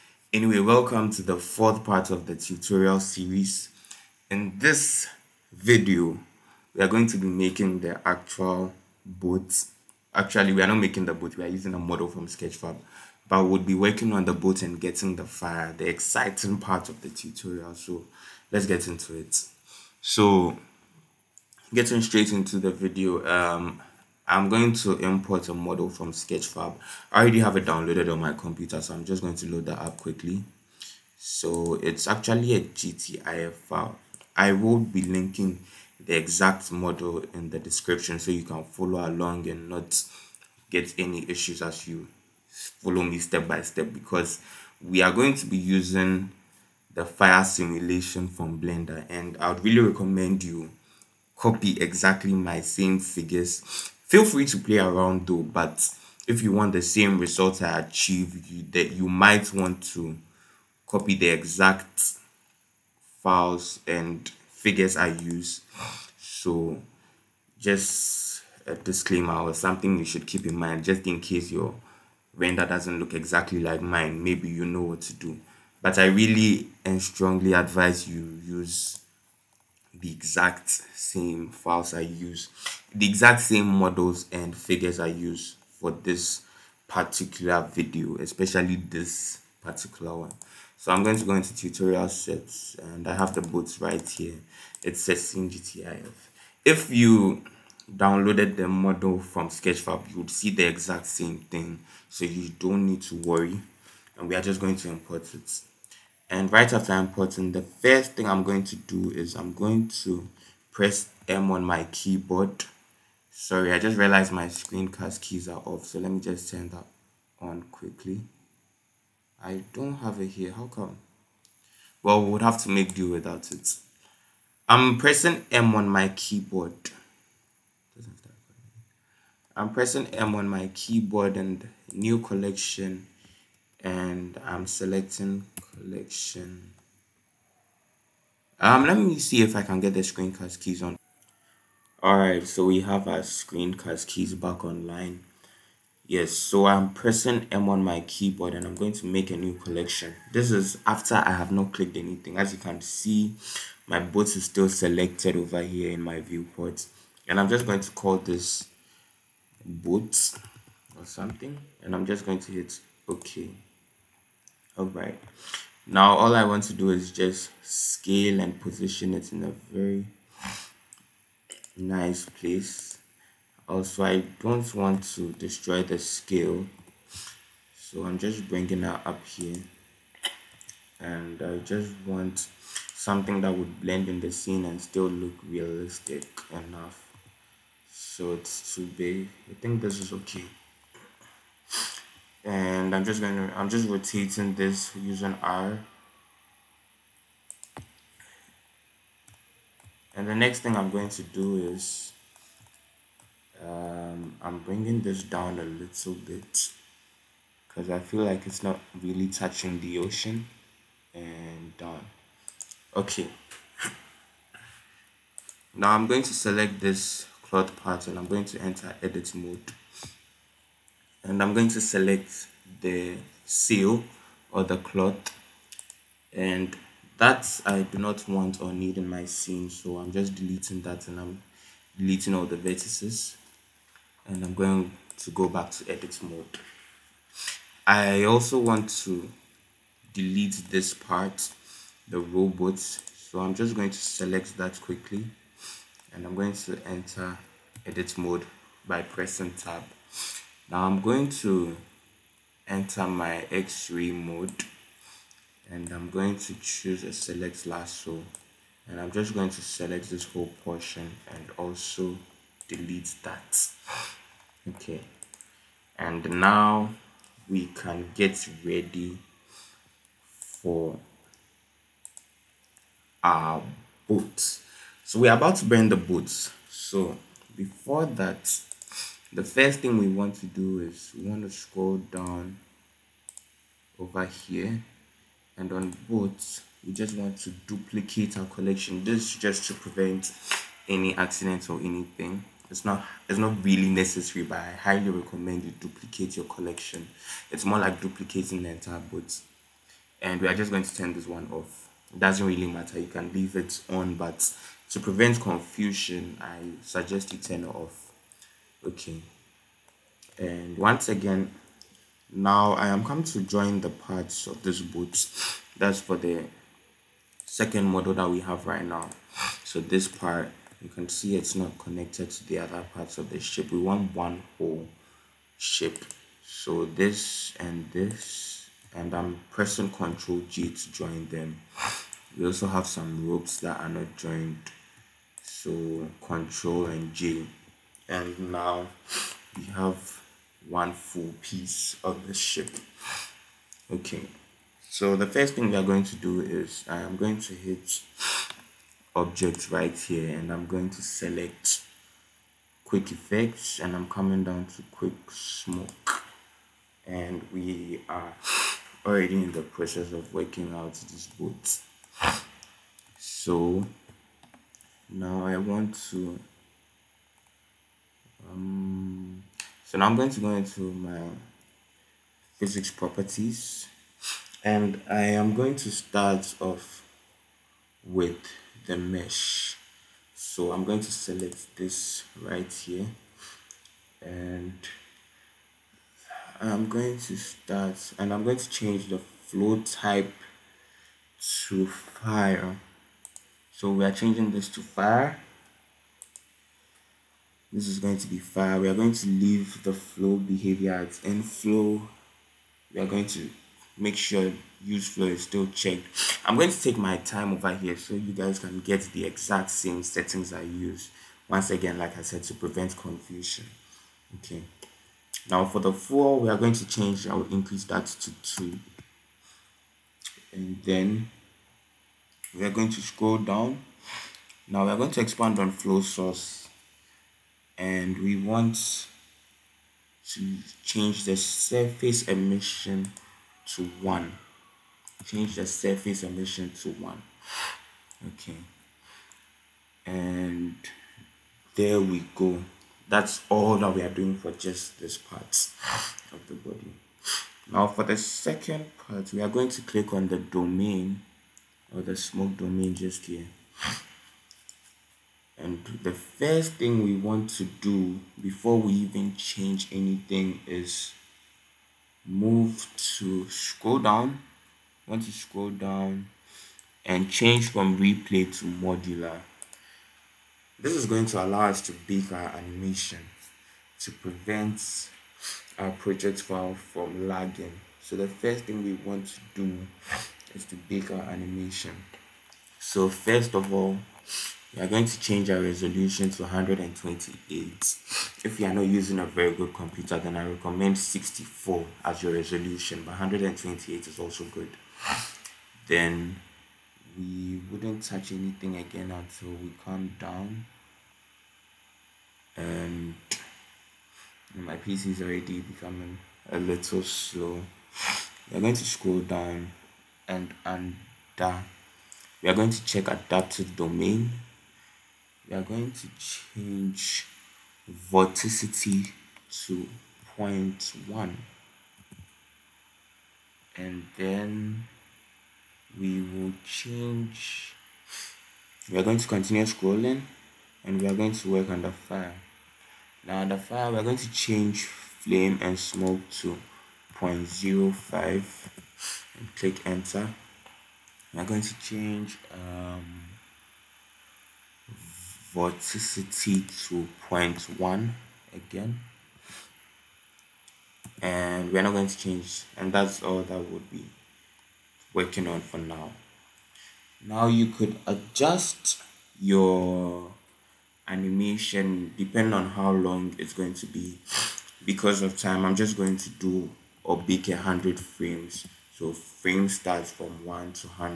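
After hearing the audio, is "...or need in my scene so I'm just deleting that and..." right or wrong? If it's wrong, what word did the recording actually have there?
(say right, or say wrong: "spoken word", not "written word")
right.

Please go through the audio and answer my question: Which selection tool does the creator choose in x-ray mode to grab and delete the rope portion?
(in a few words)
select lasso.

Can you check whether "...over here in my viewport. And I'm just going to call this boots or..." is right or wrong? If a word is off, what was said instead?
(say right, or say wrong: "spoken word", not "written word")
right.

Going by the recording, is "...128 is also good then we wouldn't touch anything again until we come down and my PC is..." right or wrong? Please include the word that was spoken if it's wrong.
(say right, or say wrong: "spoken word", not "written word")
right.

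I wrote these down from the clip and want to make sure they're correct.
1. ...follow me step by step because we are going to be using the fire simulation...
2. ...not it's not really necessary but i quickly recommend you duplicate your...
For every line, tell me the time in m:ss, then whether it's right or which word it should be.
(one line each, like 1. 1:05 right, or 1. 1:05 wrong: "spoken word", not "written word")
1. 0:42 right
2. 4:52 wrong: "highly", not "quickly".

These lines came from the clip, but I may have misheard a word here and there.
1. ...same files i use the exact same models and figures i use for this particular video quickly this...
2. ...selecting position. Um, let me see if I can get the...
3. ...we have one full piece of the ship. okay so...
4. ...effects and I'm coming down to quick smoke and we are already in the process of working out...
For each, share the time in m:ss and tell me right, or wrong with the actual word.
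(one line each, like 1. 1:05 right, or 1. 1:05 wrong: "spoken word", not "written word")
1. 1:20 wrong: "especially", not "quickly"
2. 2:14 wrong: "collection", not "position"
3. 5:39 right
4. 5:53 right.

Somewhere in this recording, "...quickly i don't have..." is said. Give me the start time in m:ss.
1:57.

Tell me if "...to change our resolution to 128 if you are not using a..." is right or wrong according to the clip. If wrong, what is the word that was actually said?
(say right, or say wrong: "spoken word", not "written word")
right.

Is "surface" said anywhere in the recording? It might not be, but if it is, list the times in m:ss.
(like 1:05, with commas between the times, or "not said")
7:11, 7:15.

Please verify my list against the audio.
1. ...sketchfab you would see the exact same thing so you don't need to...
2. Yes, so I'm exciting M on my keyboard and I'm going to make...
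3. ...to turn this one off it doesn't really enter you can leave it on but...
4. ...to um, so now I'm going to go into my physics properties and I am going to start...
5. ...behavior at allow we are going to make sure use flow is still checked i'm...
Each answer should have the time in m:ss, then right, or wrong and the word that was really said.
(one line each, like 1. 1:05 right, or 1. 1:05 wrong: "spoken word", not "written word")
1. 1:39 right
2. 2:26 wrong: "pressing", not "exciting"
3. 5:00 wrong: "matter", not "enter"
4. 6:06 right
5. 6:40 wrong: "inflow", not "allow".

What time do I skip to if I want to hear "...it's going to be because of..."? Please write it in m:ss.
9:23.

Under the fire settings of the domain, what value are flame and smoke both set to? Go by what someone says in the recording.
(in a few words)
0.05.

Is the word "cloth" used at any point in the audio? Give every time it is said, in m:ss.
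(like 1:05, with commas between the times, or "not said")
3:44.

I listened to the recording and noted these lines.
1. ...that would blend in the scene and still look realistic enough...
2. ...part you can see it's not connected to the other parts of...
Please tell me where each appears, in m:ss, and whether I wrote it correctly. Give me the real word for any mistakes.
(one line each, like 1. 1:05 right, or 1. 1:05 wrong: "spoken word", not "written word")
1. 3:03 right
2. 5:20 right.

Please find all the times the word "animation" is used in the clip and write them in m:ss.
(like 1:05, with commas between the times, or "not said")
7:52, 8:01, 9:21.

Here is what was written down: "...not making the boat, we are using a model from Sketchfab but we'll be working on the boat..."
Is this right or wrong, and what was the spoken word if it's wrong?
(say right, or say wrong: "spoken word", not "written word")
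right.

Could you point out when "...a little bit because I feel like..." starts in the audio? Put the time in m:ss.
3:25.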